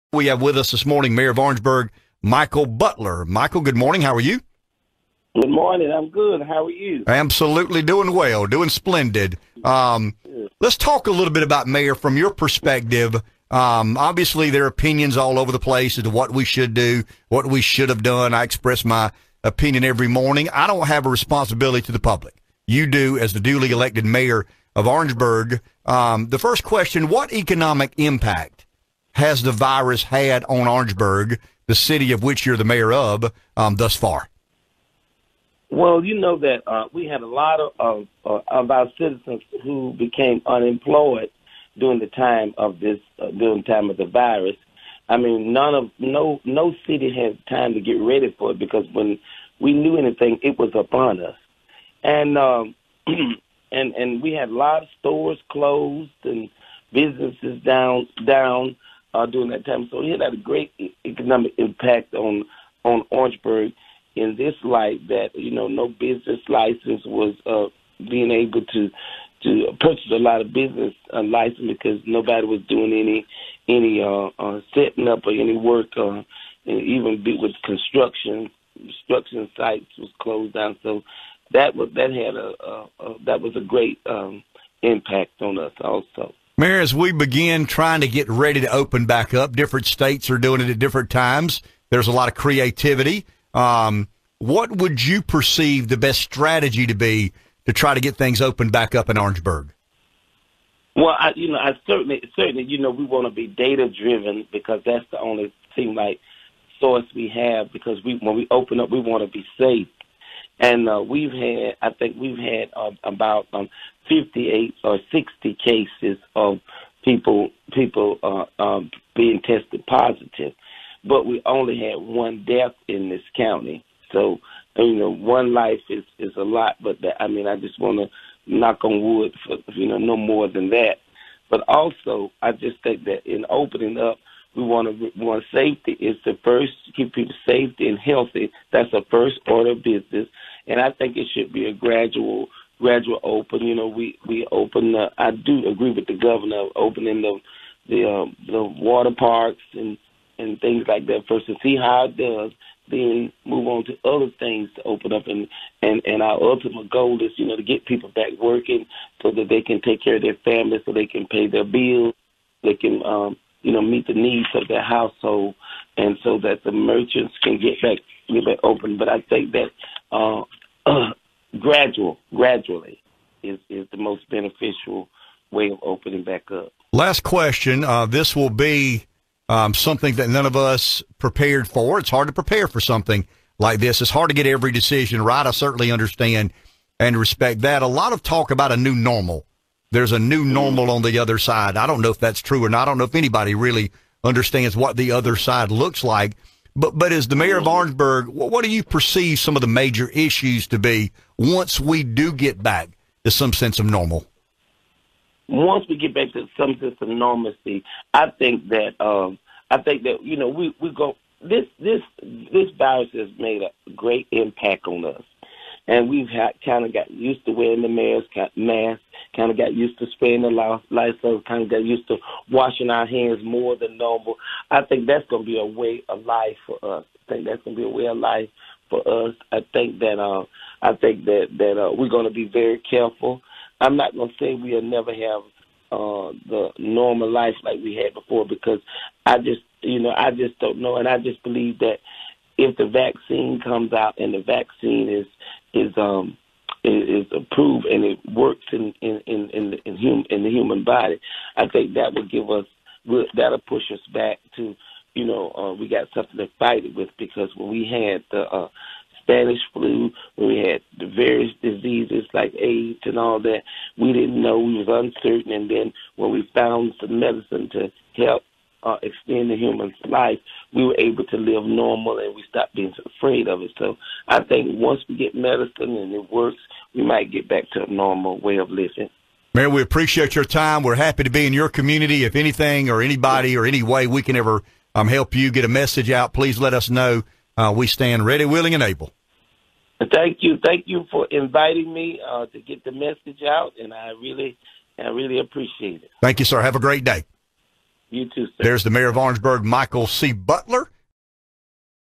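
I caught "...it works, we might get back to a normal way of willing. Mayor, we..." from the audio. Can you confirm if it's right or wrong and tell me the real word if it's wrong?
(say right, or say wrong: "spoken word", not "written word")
wrong: "living", not "willing".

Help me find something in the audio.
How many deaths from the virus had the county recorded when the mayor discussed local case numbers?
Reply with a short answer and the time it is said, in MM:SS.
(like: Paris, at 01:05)
1, at 02:01.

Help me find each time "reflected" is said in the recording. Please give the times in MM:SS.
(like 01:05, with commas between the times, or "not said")
not said.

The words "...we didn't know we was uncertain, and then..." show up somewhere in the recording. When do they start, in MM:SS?
04:23.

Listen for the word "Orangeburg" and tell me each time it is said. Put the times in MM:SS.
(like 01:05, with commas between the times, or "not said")
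00:01, 00:24, 00:30, 01:03, 01:39, 03:17, 04:59.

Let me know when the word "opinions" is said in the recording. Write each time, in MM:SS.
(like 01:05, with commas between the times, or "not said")
00:14, 00:19.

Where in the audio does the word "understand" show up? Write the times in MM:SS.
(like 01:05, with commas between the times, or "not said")
03:05, 03:14.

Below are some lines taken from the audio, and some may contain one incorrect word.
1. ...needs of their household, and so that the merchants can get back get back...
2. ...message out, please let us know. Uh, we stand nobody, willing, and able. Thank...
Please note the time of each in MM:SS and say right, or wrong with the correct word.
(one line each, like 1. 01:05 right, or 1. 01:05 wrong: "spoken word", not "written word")
1. 02:44 right
2. 04:45 wrong: "ready", not "nobody".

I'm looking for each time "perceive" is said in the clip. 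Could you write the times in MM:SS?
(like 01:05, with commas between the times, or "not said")
01:35, 03:18.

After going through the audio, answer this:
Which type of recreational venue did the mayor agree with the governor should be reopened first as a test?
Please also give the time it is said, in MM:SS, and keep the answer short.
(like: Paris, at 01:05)
water parks, at 02:28.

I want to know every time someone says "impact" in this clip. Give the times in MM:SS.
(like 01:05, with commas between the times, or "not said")
00:27, 01:01, 01:24, 03:34.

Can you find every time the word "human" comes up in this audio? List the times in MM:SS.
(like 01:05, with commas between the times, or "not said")
04:10, 04:29.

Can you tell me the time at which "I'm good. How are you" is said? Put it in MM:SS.
00:05.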